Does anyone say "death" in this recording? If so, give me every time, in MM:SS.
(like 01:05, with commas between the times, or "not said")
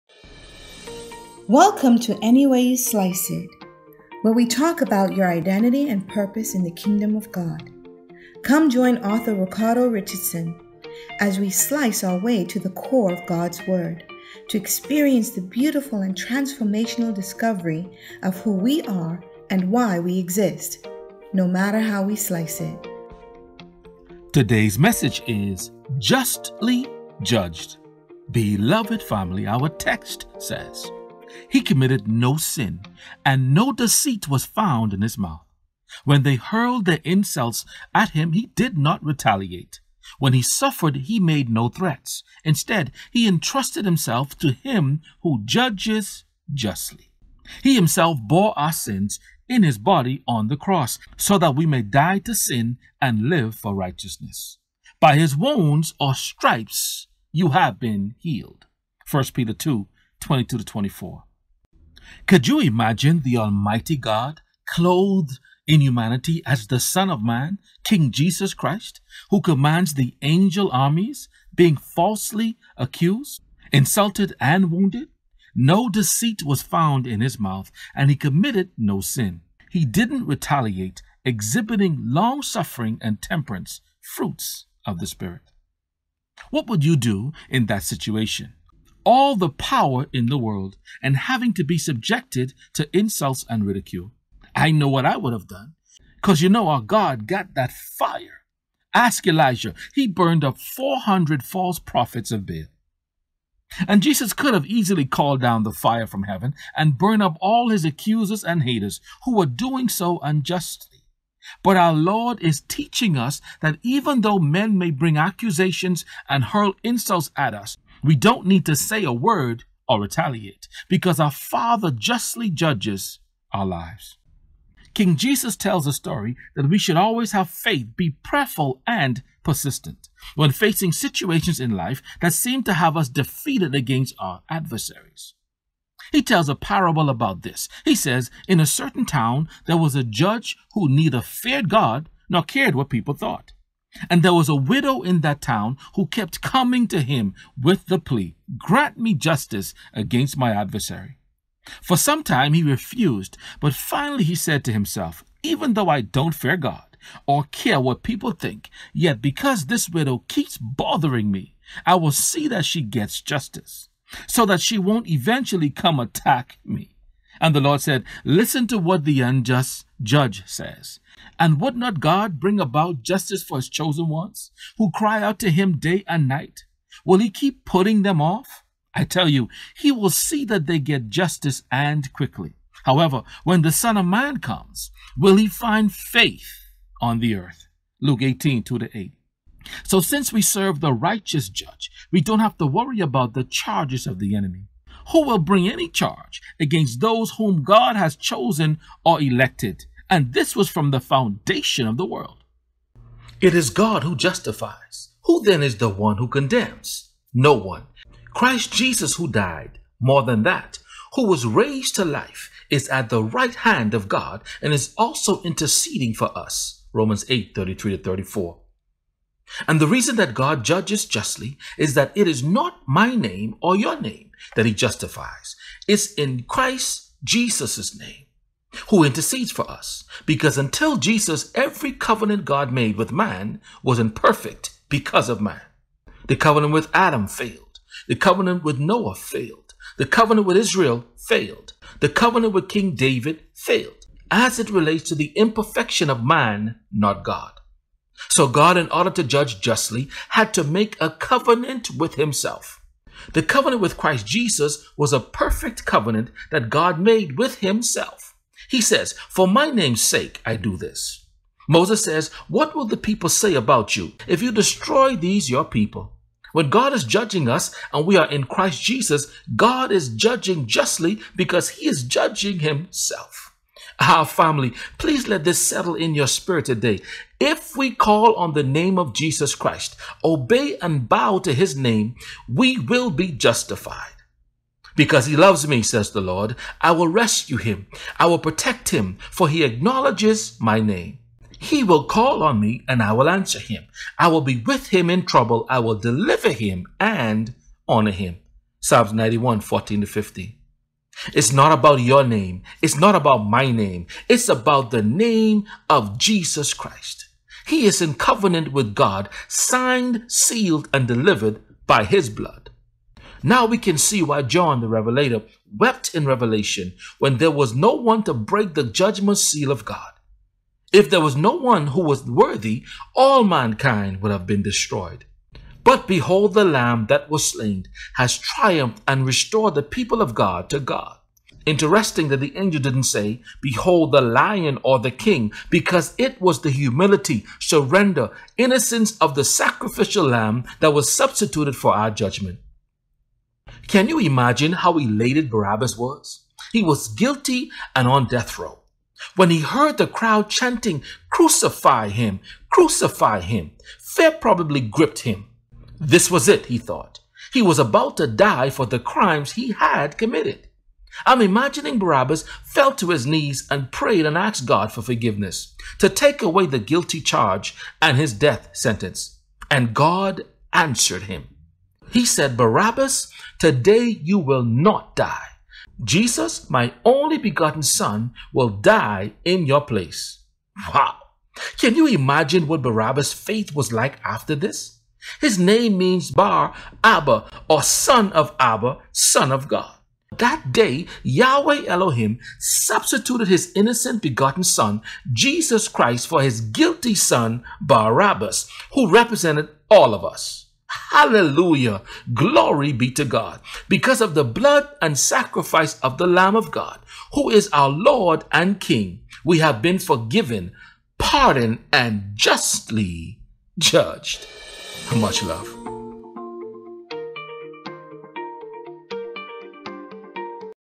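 05:48, 06:08.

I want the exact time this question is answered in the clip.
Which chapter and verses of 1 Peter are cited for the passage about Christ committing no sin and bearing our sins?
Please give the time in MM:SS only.
00:59.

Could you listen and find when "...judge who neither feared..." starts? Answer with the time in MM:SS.
02:20.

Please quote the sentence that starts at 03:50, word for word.
Because until Jesus, every covenant God made with man was imperfect because of man.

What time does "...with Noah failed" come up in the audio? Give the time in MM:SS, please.
03:58.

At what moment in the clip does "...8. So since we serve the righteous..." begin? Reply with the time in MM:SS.
03:08.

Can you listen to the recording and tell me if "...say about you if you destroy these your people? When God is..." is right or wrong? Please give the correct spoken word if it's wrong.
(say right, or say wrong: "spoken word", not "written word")
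right.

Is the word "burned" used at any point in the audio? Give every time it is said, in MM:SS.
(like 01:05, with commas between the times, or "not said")
01:40, 01:46.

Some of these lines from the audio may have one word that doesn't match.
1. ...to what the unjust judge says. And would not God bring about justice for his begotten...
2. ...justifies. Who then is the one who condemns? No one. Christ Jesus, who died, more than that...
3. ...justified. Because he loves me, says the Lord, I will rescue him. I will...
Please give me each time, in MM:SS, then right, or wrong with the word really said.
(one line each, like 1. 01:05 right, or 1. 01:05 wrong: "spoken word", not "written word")
1. 02:48 wrong: "chosen", not "begotten"
2. 03:24 right
3. 04:43 right.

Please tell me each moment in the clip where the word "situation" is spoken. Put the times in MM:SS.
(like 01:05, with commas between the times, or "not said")
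01:27, 02:10.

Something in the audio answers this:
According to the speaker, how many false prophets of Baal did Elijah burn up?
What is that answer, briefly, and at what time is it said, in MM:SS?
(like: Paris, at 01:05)
400, at 01:40.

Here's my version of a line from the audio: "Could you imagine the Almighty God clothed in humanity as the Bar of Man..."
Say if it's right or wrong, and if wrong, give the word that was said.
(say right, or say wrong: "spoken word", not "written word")
wrong: "Son", not "Bar".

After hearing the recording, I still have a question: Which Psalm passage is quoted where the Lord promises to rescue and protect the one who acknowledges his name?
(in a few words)
Psalms 91:14-15.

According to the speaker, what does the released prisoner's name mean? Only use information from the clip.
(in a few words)
son of Abba.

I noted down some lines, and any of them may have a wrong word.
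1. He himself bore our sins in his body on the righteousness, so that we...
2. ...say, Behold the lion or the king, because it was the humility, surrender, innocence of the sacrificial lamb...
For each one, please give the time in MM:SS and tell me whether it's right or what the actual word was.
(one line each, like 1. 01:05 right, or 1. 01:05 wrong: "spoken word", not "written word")
1. 00:47 wrong: "cross", not "righteousness"
2. 05:33 right.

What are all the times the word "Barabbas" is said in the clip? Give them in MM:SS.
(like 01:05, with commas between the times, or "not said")
05:45, 06:01, 06:12, 06:22, 06:37.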